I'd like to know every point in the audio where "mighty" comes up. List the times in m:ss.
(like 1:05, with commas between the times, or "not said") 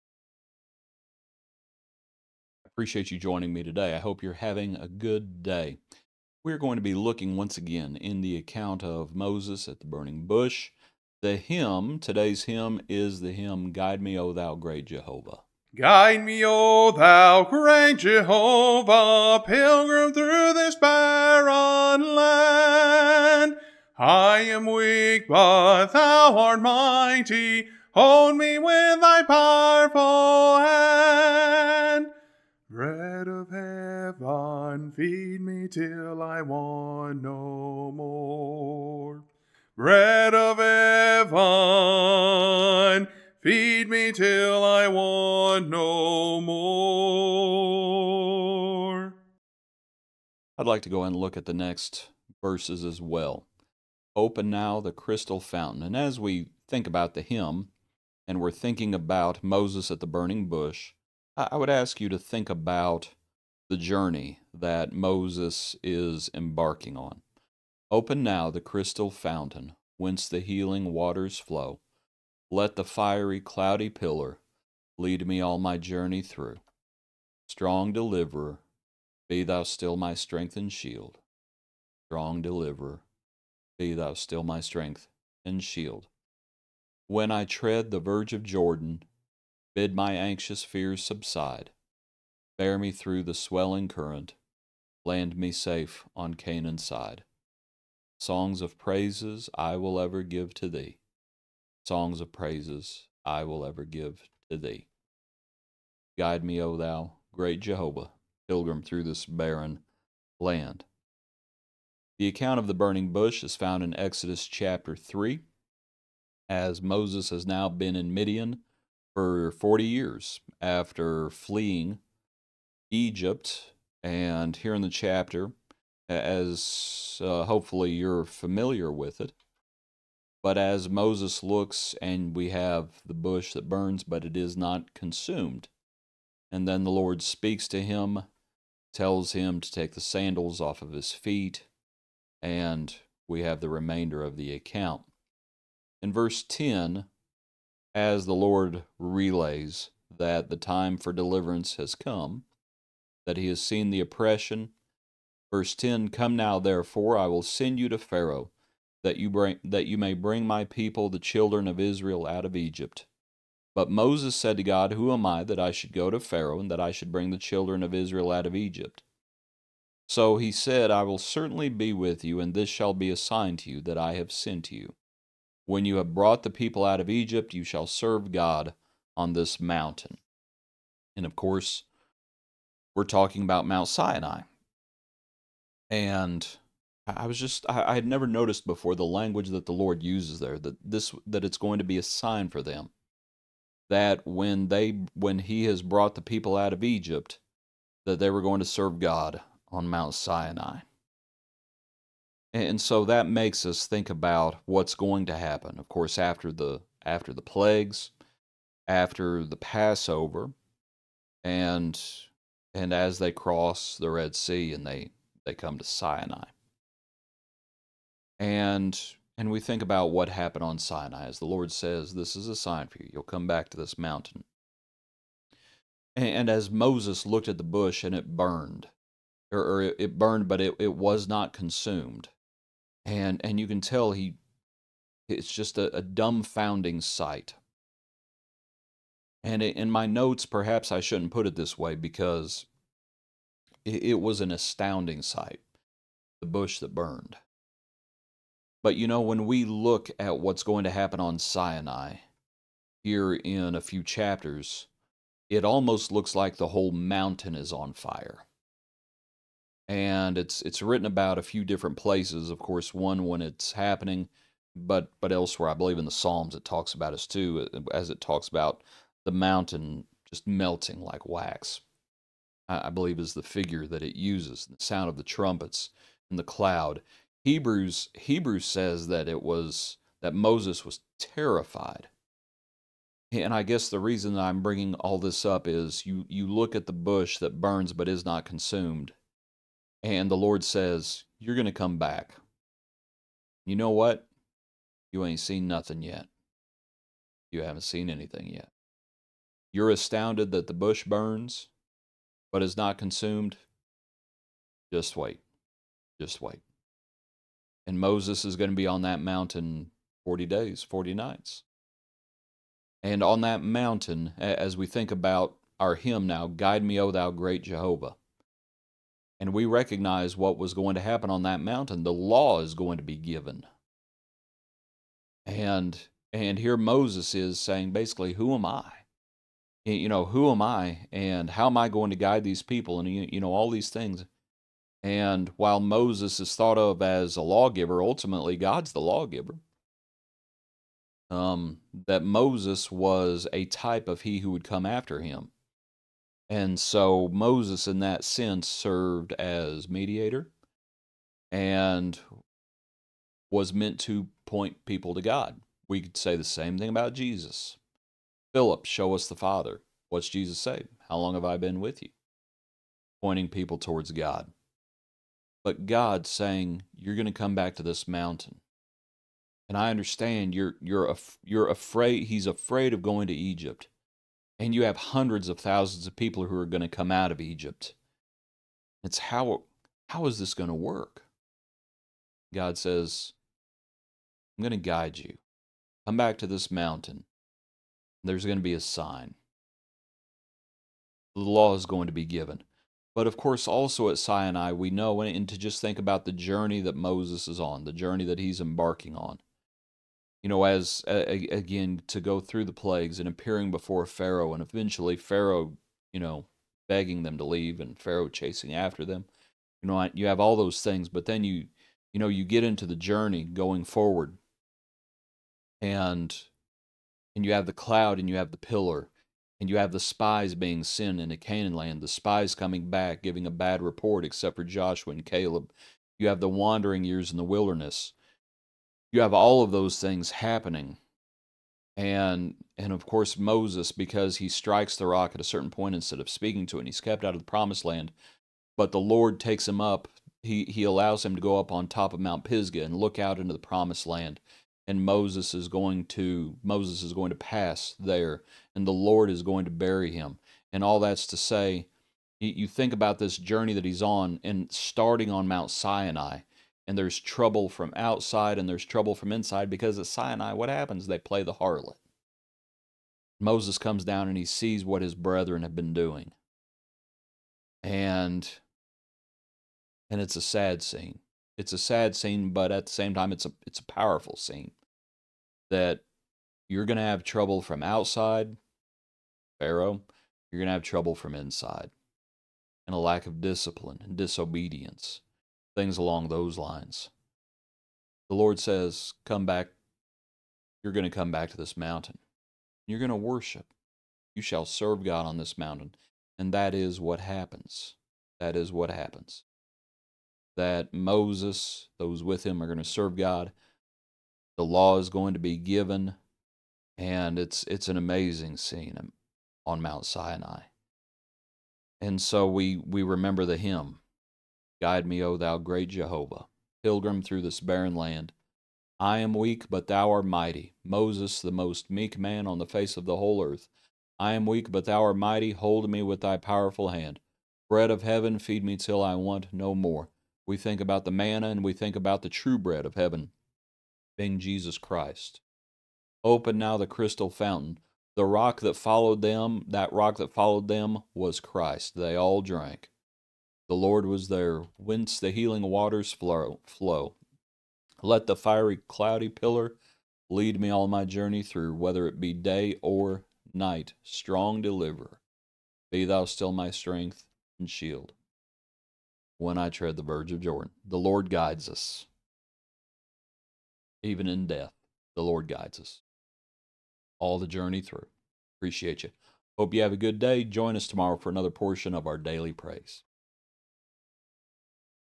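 0:26, 8:40, 8:45.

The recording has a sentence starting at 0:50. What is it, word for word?
I'd like to go and look at the next verses as well.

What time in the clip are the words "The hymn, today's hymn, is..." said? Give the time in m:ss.
0:11.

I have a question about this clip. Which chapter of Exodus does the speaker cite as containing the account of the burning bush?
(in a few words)
Chapter 3.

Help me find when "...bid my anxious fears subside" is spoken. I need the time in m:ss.
1:29.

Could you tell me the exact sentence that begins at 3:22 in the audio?
And so that makes us think about what's going to happen.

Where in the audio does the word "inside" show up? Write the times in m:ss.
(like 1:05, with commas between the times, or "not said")
7:39, 8:01.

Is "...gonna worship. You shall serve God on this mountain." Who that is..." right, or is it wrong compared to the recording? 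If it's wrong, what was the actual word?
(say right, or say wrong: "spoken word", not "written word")
wrong: "And", not "Who".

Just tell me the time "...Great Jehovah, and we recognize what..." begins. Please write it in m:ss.
5:17.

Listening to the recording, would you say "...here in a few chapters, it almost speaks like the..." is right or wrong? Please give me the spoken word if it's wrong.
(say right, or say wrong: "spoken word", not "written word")
wrong: "looks", not "speaks".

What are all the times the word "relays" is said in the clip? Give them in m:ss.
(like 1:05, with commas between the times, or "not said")
2:28.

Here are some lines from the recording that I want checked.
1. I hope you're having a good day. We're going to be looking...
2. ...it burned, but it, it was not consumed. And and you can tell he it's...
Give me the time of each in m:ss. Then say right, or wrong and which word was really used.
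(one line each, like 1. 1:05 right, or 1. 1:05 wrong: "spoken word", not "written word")
1. 0:03 right
2. 3:49 right.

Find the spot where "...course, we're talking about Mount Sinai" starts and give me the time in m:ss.
3:01.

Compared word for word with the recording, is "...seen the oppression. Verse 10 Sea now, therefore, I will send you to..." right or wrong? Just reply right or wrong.
wrong.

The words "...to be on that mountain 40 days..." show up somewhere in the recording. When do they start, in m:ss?
5:08.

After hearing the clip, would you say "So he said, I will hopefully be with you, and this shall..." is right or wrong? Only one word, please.
wrong.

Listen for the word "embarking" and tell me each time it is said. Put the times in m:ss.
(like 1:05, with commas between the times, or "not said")
1:06, 6:38.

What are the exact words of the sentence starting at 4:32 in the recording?
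I, believe is the figure that it uses, the sound of the trumpets and the cloud.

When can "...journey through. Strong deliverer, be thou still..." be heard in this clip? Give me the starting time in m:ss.
1:15.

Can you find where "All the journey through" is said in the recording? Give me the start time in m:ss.
9:27.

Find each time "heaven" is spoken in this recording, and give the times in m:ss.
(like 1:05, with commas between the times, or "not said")
0:40, 8:48, 8:52.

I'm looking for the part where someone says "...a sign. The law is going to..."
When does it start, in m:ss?
6:28.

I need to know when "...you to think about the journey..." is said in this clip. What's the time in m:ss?
1:01.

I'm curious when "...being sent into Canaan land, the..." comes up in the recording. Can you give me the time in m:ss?
7:00.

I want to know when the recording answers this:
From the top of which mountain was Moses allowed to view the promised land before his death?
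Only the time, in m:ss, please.
7:22.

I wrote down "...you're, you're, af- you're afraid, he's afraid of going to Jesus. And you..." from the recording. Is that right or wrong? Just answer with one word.
wrong.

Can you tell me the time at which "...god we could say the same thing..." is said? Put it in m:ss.
5:55.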